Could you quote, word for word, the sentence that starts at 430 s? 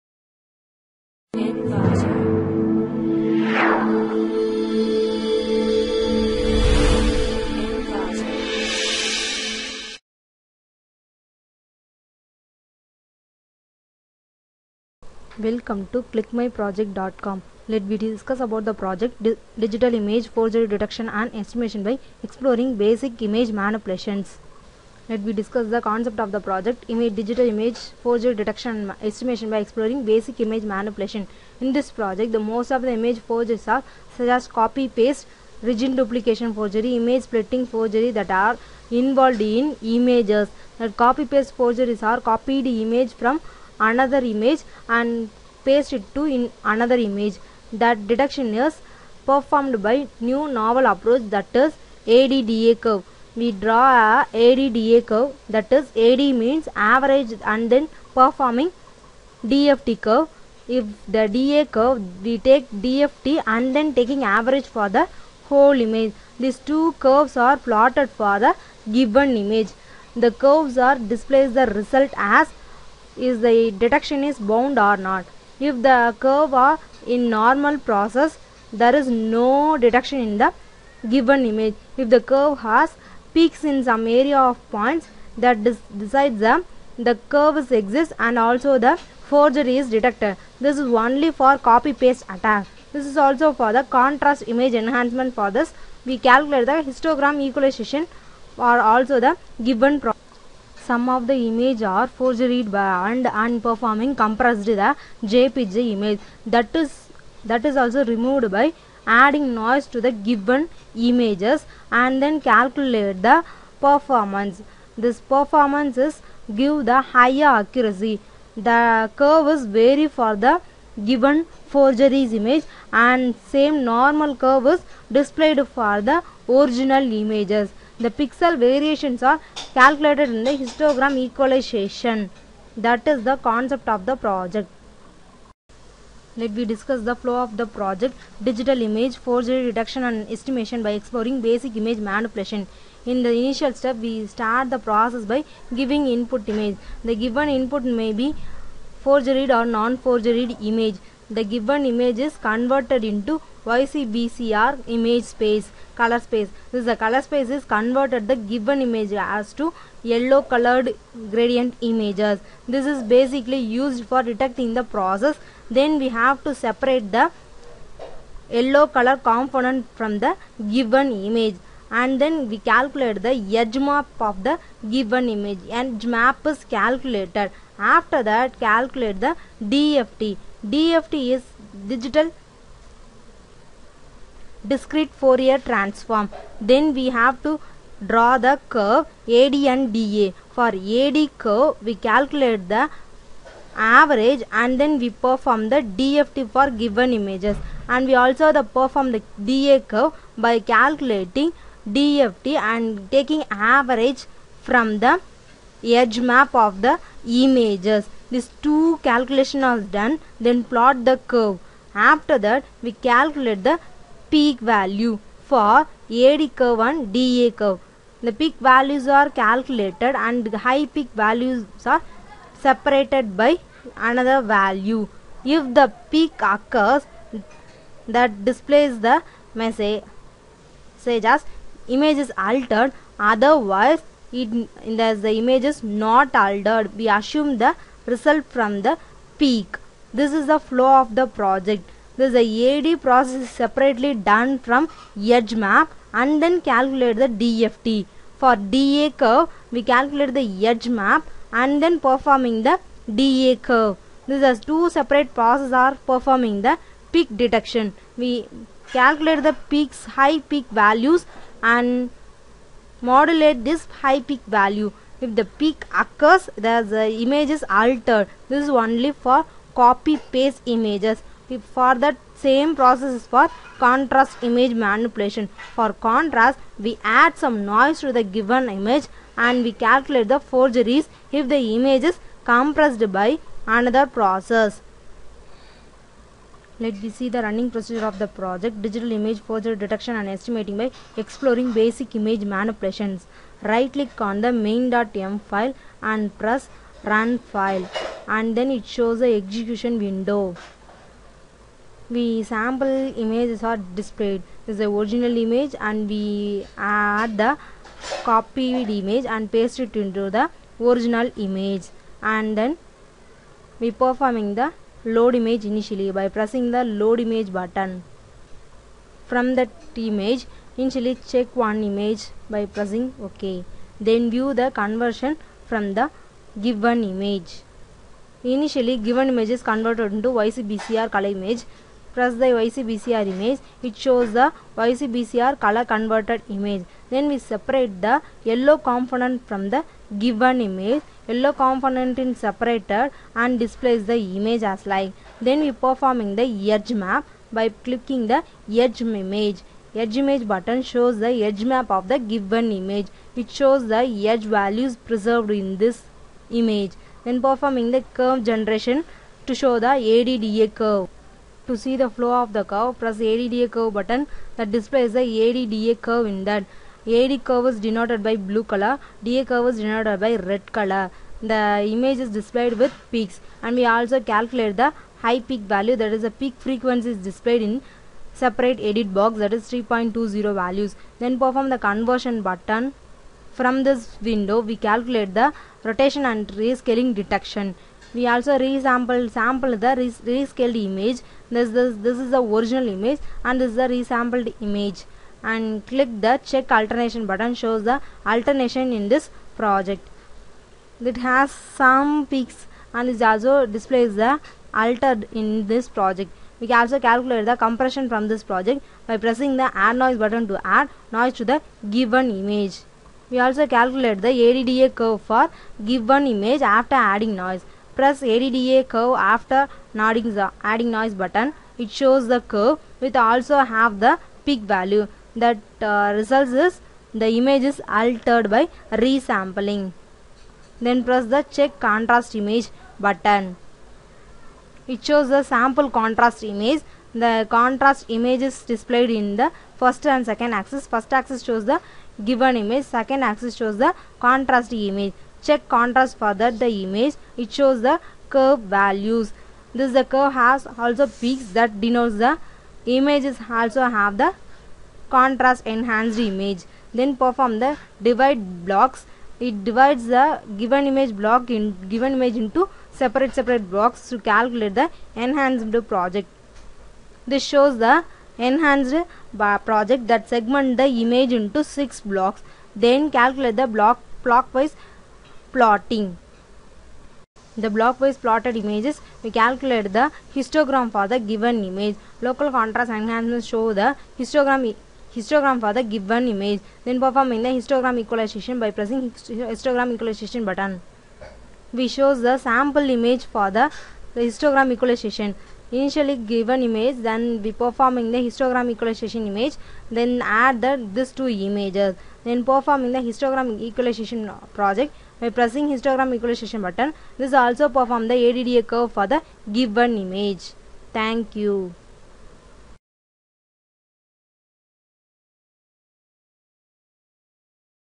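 Then press the check contrast image button.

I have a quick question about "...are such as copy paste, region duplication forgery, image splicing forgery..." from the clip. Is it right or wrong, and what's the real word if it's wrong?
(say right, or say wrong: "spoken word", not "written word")
right.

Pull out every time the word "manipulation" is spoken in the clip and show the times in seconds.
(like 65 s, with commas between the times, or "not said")
23 s, 30 s, 142 s, 274 s, 292 s.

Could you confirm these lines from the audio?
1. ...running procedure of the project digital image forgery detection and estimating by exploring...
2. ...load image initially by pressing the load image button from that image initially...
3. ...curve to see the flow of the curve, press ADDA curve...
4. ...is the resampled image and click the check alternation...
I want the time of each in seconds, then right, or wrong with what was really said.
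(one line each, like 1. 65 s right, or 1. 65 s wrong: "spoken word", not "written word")
1. 287 s right
2. 315 s right
3. 360 s right
4. 393 s right.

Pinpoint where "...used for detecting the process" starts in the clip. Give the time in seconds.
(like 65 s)
163 s.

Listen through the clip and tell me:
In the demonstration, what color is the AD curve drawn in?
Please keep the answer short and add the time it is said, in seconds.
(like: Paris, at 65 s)
Blue, at 368 s.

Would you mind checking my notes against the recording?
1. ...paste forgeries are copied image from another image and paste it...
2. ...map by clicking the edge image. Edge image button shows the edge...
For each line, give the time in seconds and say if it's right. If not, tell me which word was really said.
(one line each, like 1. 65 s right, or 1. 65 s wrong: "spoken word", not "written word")
1. 41 s right
2. 346 s right.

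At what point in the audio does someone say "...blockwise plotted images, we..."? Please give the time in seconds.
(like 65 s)
477 s.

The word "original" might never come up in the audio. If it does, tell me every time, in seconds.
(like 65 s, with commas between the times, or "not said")
126 s, 304 s, 310 s, 392 s.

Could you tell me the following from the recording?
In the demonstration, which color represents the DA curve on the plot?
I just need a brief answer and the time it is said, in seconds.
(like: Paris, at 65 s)
Red, at 370 s.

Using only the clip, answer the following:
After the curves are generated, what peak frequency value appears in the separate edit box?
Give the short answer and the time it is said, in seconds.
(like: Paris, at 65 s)
3.20, at 379 s.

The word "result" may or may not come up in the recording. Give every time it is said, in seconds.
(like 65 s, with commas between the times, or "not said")
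71 s, 238 s, 426 s.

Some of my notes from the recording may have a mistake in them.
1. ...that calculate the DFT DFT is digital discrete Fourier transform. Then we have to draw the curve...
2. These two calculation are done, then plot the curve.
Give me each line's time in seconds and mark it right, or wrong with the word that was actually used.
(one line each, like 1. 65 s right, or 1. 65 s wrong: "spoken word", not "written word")
1. 178 s right
2. 208 s right.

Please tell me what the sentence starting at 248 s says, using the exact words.
For DA curve, we calculate the edge map and then performing the DA curve.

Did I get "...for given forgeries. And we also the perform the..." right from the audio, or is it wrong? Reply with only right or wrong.
wrong.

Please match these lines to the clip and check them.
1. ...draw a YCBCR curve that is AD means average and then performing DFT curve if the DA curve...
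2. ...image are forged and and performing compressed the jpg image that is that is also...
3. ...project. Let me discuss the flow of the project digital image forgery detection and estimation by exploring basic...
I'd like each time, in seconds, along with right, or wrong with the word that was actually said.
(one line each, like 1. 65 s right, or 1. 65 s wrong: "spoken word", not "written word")
1. 53 s wrong: "ADDA", not "YCBCR"
2. 101 s right
3. 134 s right.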